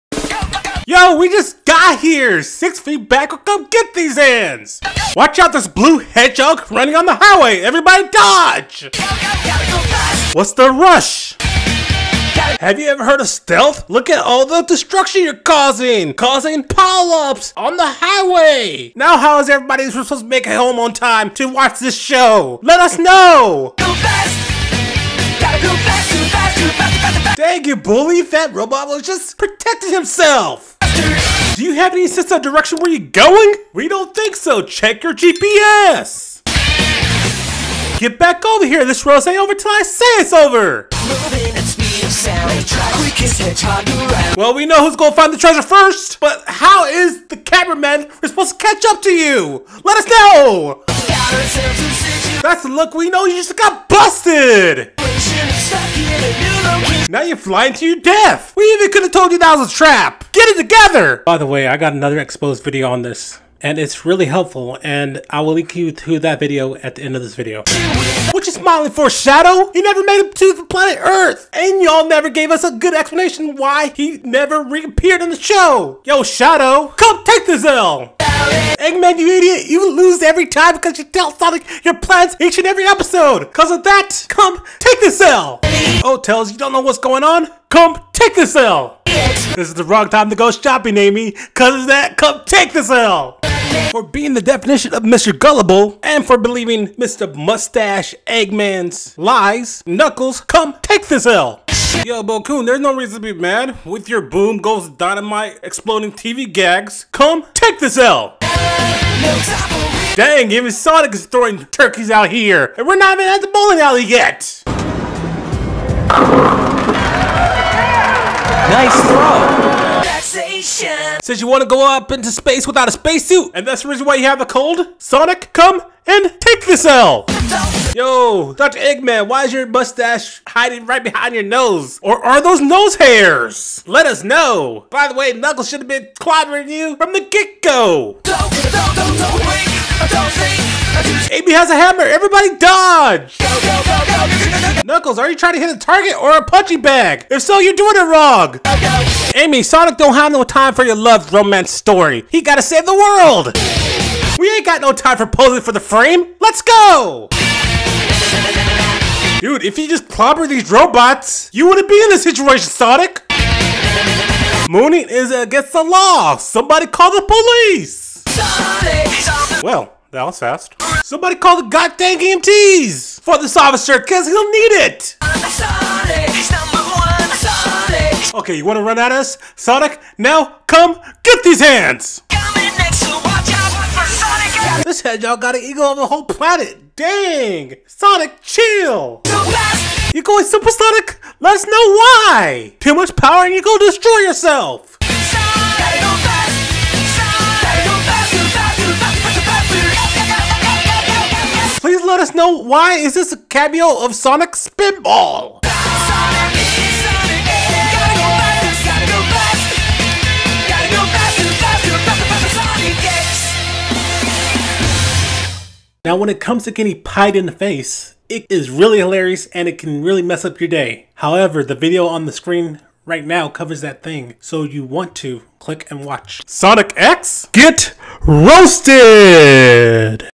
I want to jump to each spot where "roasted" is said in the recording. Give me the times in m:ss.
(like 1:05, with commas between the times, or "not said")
3:48.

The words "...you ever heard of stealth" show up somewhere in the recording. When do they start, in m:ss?
0:12.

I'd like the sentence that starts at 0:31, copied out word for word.
Do you have any sense of direction where you're going?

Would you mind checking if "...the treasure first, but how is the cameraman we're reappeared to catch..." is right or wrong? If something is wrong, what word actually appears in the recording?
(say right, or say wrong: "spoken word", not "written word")
wrong: "supposed", not "reappeared".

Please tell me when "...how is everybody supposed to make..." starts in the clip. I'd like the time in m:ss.
0:19.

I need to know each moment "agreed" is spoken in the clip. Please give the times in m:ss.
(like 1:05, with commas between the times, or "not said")
not said.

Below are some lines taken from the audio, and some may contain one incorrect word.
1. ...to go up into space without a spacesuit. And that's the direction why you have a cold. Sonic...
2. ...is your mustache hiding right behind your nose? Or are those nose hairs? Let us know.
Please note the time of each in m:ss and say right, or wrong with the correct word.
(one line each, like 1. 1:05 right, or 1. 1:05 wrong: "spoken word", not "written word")
1. 2:01 wrong: "reason", not "direction"
2. 2:09 right.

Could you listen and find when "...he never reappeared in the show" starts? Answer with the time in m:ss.
1:13.